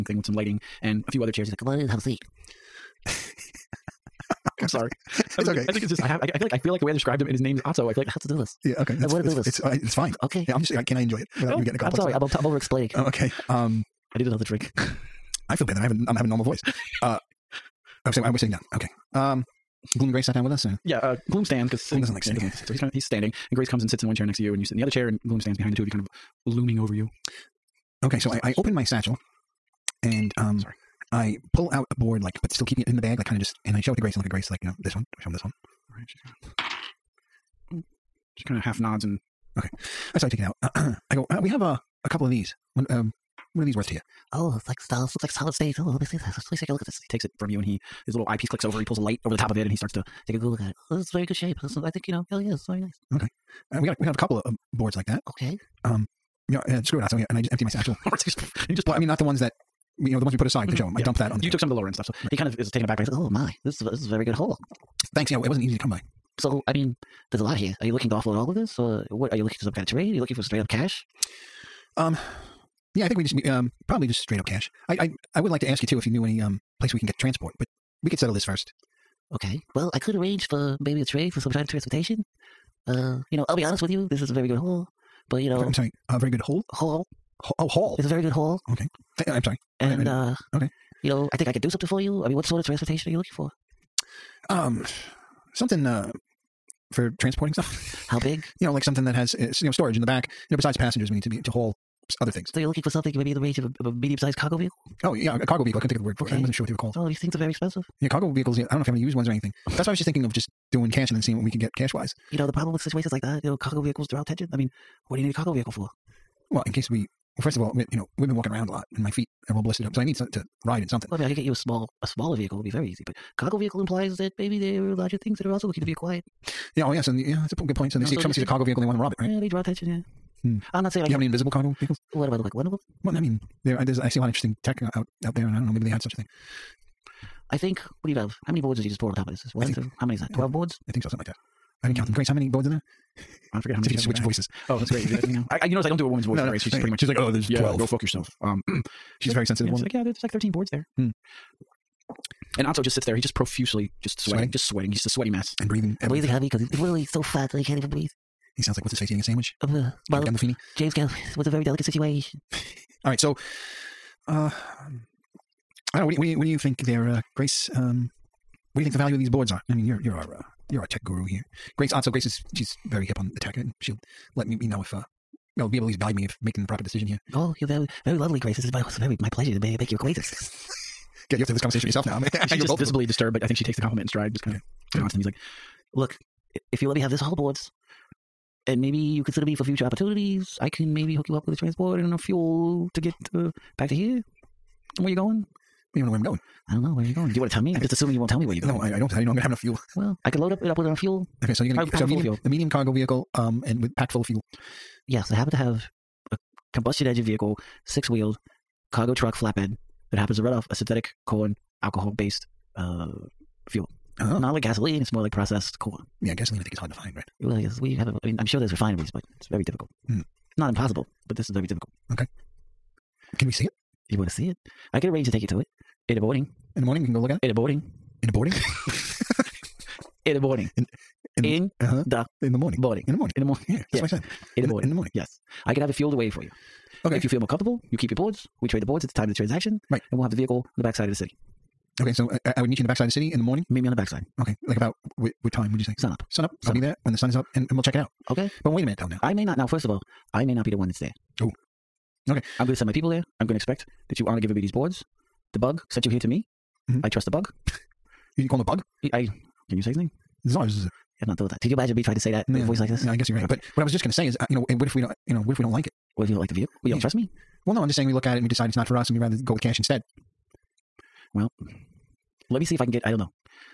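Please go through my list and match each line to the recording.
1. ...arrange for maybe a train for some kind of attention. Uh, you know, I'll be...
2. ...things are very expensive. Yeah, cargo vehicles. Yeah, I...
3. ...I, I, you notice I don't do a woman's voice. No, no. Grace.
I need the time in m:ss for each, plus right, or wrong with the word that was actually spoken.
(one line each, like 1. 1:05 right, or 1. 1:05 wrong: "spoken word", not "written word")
1. 1:20 wrong: "transportation", not "attention"
2. 1:47 right
3. 2:25 right.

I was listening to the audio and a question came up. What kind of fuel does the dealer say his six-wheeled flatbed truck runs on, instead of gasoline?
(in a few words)
Synthetic corn alcohol.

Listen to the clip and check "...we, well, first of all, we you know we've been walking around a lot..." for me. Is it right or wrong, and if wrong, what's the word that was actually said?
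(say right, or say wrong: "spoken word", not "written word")
right.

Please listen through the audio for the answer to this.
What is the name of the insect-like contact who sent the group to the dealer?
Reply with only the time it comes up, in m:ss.
4:20.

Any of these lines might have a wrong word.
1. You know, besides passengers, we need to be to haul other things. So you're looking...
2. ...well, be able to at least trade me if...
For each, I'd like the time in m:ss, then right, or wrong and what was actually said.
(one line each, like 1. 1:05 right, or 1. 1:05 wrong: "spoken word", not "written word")
1. 1:40 right
2. 2:55 wrong: "guide", not "trade".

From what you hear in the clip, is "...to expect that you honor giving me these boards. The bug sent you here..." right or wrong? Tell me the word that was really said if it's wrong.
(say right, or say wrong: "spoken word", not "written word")
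right.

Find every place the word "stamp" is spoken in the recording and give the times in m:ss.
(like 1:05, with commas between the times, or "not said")
not said.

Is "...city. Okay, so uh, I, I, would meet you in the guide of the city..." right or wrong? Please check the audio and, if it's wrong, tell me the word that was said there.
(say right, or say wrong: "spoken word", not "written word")
wrong: "backside", not "guide".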